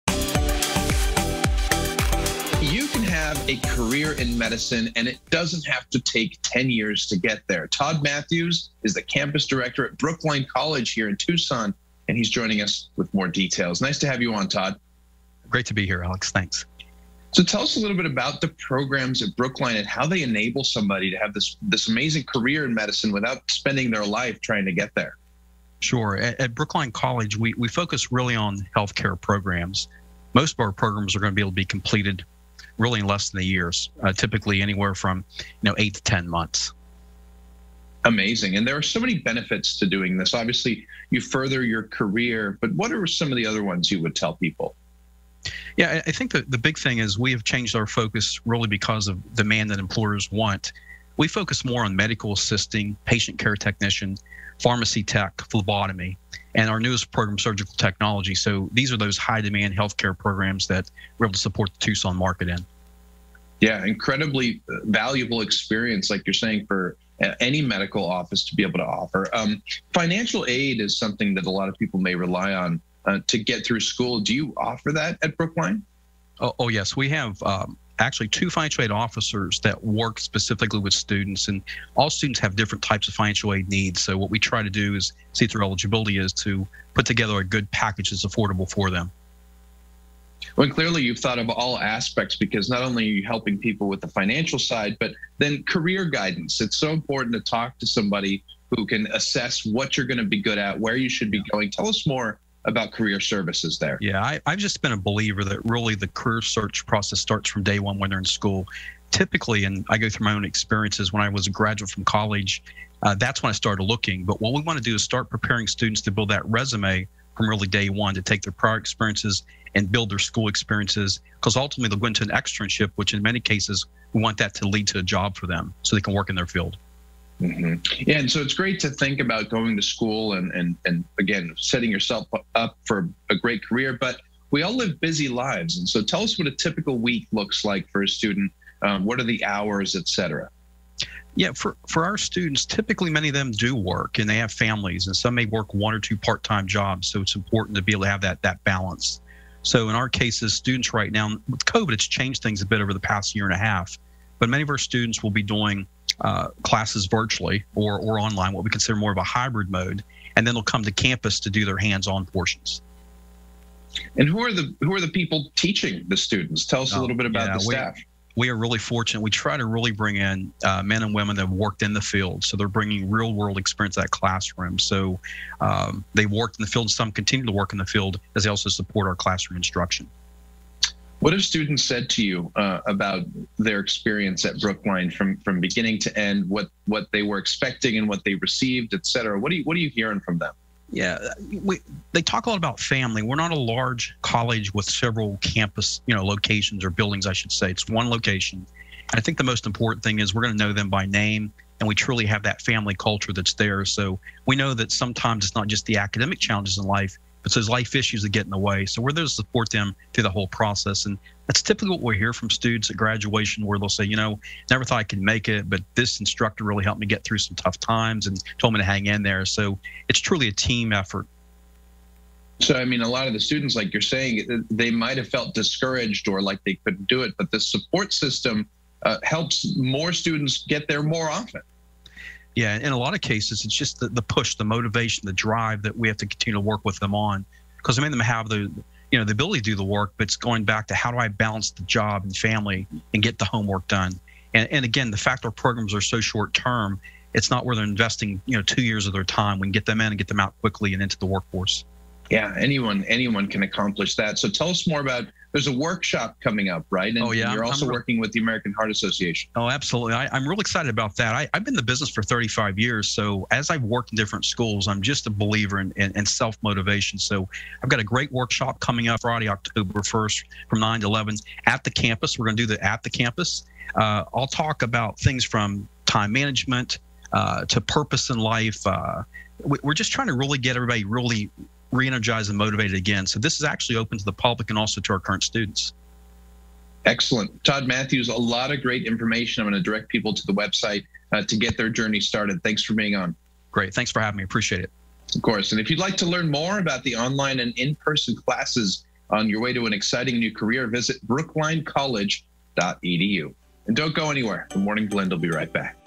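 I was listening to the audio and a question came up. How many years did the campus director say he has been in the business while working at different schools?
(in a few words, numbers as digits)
35.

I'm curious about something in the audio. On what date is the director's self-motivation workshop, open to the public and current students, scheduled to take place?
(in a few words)
Friday, October 1.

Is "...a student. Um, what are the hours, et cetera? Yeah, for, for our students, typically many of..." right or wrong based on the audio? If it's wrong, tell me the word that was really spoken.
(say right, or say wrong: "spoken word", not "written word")
right.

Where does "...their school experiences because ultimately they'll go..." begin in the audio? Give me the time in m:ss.
2:00.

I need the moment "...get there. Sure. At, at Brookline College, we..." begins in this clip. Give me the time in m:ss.
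0:24.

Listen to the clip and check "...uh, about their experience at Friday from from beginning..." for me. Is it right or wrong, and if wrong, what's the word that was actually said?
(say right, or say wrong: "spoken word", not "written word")
wrong: "Brookline", not "Friday".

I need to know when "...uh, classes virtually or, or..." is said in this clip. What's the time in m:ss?
2:36.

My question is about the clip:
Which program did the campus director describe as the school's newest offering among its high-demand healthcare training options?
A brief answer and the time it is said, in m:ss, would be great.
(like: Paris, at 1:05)
surgical technology, at 0:57.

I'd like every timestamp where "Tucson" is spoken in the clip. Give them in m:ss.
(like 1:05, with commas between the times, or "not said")
0:11, 1:01.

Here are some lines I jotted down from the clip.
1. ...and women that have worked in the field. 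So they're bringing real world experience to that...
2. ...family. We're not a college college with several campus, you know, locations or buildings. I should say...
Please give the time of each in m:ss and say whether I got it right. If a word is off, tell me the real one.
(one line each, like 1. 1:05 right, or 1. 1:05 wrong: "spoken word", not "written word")
1. 2:51 right
2. 3:12 wrong: "large", not "college".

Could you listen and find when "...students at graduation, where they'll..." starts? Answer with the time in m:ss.
3:32.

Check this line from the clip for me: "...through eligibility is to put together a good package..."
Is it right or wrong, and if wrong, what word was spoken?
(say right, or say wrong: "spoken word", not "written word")
right.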